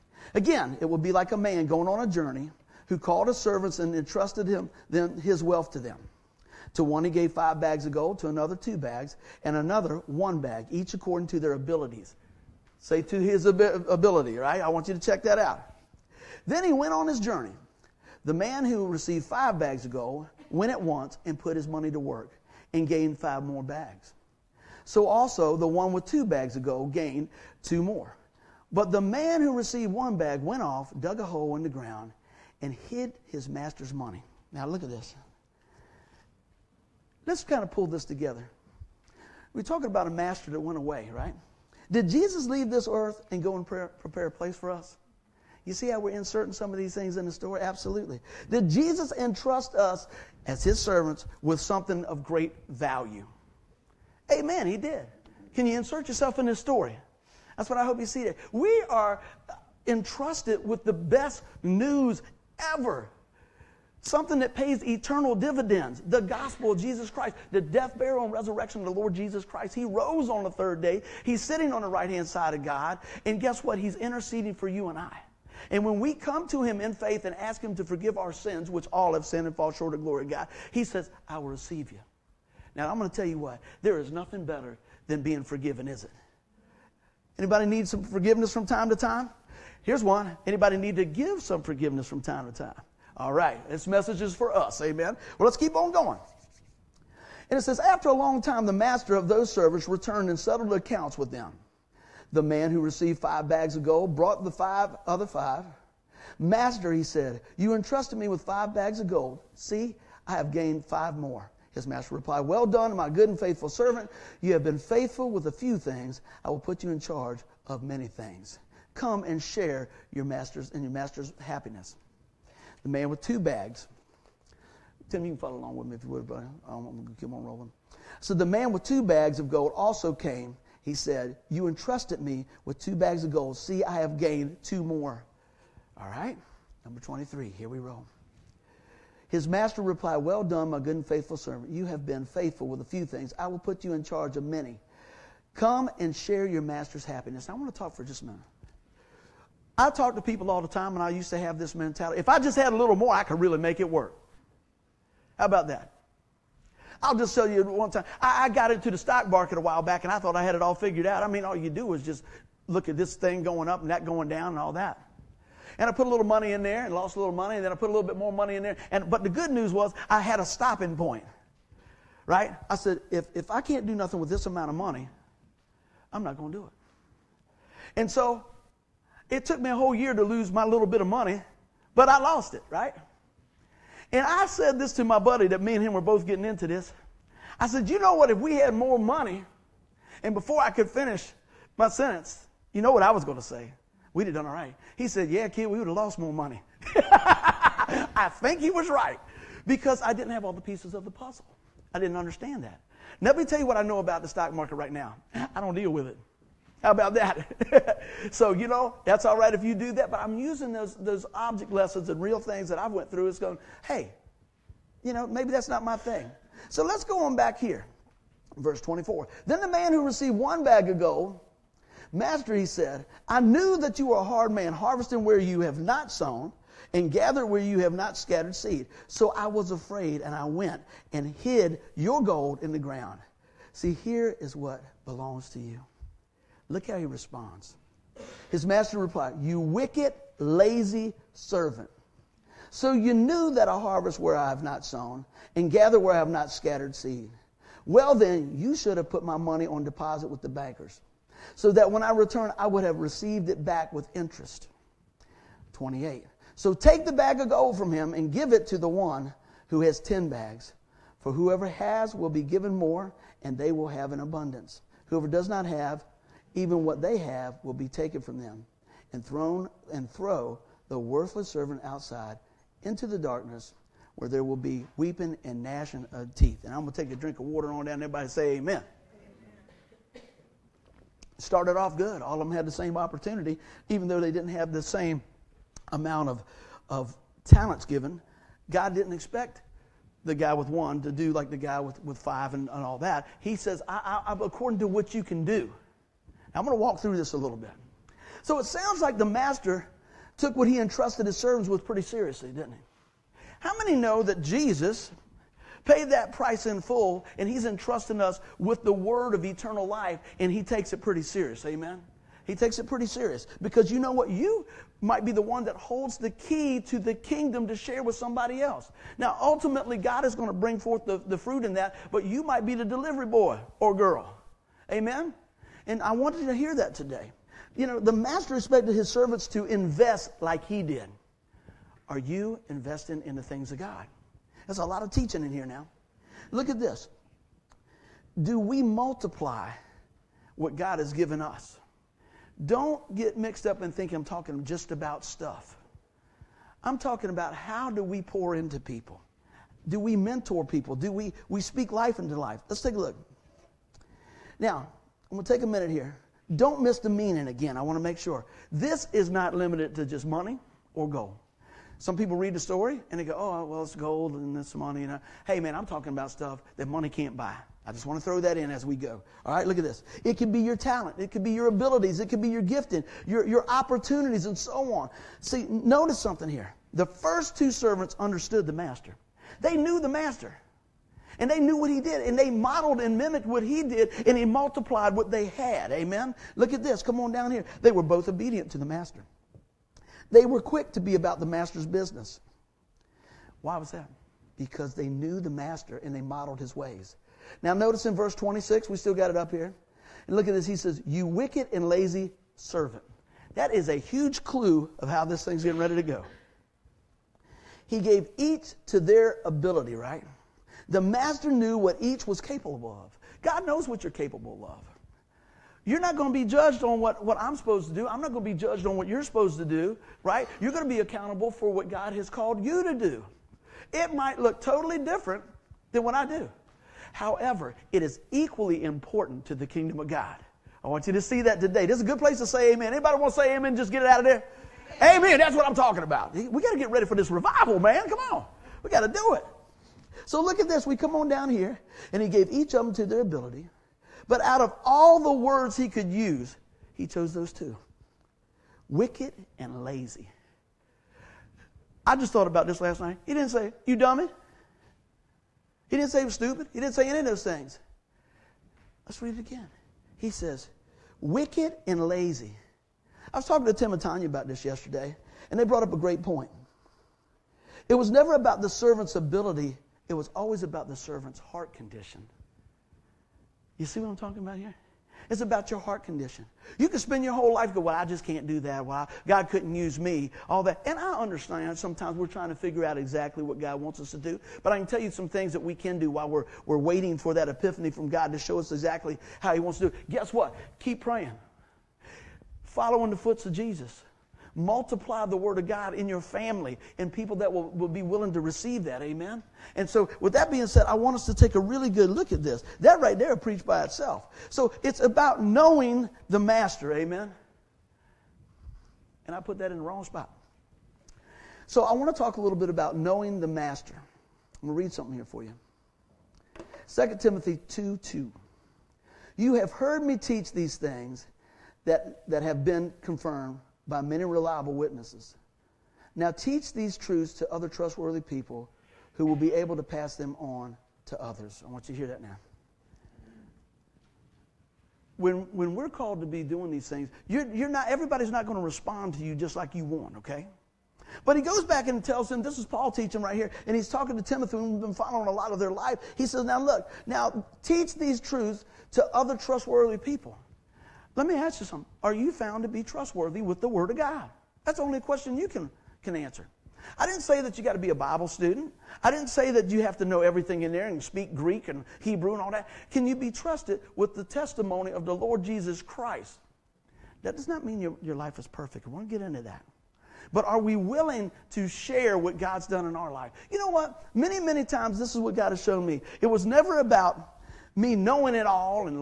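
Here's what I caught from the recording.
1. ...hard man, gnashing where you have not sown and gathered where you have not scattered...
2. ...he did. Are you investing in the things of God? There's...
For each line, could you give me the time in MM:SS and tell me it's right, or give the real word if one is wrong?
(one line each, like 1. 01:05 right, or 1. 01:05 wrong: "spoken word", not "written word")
1. 03:44 wrong: "harvesting", not "gnashing"
2. 05:30 right.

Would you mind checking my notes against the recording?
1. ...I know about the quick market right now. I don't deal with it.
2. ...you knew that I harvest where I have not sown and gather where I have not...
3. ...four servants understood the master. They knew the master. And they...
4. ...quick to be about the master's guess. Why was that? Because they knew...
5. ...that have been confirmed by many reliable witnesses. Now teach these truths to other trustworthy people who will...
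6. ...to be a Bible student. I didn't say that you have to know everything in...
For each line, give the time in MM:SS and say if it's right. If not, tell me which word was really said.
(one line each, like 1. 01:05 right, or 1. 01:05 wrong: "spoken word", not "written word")
1. 03:23 wrong: "stock", not "quick"
2. 04:02 right
3. 06:17 wrong: "two", not "four"
4. 06:30 wrong: "business", not "guess"
5. 08:42 right
6. 09:17 right.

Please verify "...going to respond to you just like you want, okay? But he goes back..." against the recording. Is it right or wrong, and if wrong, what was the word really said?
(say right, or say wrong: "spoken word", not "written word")
right.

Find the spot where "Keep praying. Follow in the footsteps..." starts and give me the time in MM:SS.
08:10.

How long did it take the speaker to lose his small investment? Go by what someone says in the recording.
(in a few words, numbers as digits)
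A whole year.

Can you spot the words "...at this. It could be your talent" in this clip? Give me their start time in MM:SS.
06:09.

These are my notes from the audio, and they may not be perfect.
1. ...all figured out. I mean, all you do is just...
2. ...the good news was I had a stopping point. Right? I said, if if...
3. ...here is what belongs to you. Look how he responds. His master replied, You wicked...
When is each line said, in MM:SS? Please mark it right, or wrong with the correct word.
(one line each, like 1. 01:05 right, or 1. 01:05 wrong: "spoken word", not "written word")
1. 02:40 right
2. 02:49 right
3. 03:54 right.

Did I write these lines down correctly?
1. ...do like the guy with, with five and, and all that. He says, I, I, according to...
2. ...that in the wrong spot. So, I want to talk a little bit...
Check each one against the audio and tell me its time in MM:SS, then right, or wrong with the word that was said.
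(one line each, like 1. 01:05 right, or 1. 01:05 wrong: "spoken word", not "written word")
1. 04:51 right
2. 08:29 right.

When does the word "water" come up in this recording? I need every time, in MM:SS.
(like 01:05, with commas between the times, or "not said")
04:37.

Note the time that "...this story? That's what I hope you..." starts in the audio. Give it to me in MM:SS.
00:56.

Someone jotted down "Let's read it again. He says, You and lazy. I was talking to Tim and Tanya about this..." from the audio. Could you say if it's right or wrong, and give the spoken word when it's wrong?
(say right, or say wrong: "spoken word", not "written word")
wrong: "Wicked", not "You".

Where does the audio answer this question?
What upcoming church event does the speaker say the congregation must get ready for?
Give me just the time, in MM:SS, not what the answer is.
07:17.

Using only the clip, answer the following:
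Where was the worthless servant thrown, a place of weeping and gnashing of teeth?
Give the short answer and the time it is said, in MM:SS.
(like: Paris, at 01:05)
Outside into the darkness, at 04:31.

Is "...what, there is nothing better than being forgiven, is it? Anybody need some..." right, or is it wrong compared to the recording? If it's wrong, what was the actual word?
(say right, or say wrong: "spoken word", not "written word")
right.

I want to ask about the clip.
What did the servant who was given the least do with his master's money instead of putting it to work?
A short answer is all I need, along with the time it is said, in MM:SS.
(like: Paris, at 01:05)
Dug a hole, at 00:30.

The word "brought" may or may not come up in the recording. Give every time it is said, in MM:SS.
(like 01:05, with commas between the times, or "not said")
01:44, 07:45.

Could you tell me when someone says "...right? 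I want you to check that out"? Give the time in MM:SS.
00:14.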